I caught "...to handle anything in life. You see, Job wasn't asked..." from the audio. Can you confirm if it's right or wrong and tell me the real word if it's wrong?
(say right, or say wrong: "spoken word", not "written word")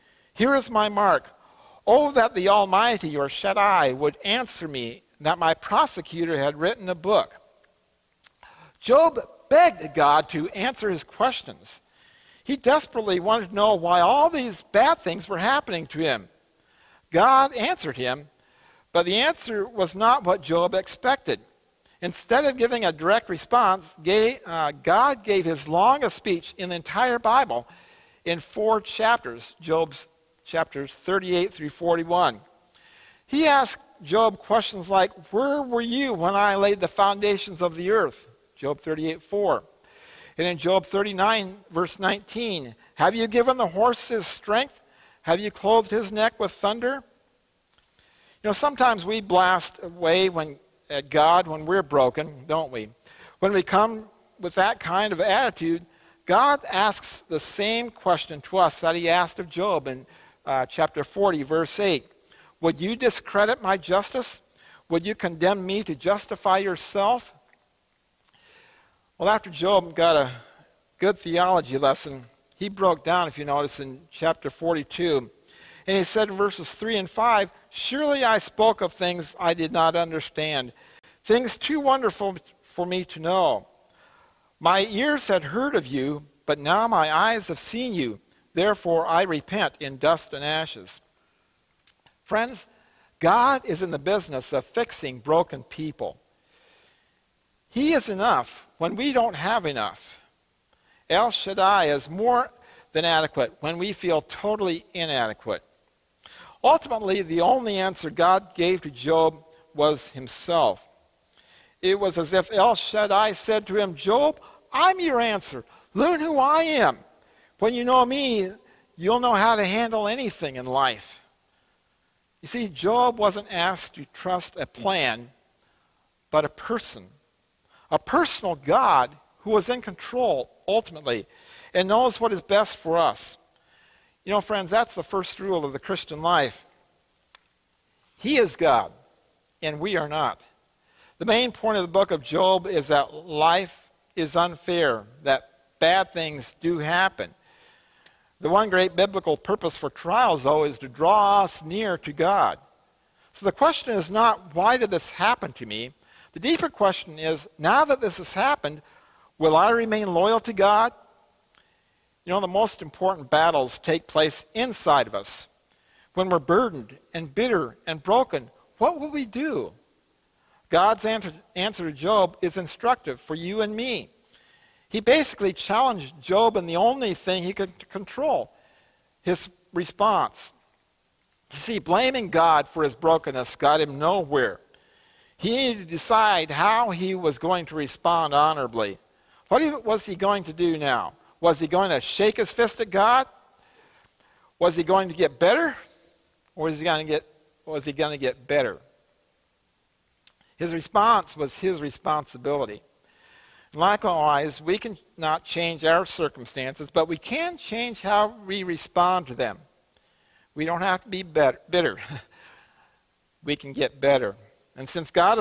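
right.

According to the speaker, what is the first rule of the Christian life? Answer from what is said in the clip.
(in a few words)
He is God, and we are not.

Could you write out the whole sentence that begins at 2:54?
He basically challenged Job in the only thing he could control his response.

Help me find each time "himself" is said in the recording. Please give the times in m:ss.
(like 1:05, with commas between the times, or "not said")
1:50.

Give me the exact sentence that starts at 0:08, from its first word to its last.
Job begged God to answer his questions.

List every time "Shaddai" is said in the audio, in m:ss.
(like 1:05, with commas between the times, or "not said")
0:03, 1:41, 1:52.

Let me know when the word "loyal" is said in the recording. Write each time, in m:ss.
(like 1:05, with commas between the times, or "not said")
2:40.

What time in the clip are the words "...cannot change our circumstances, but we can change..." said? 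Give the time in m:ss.
3:24.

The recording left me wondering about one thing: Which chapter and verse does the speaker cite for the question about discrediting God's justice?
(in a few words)
Chapter 40, verse 8.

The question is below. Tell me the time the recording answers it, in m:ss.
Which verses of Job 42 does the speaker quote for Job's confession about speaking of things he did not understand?
1:16.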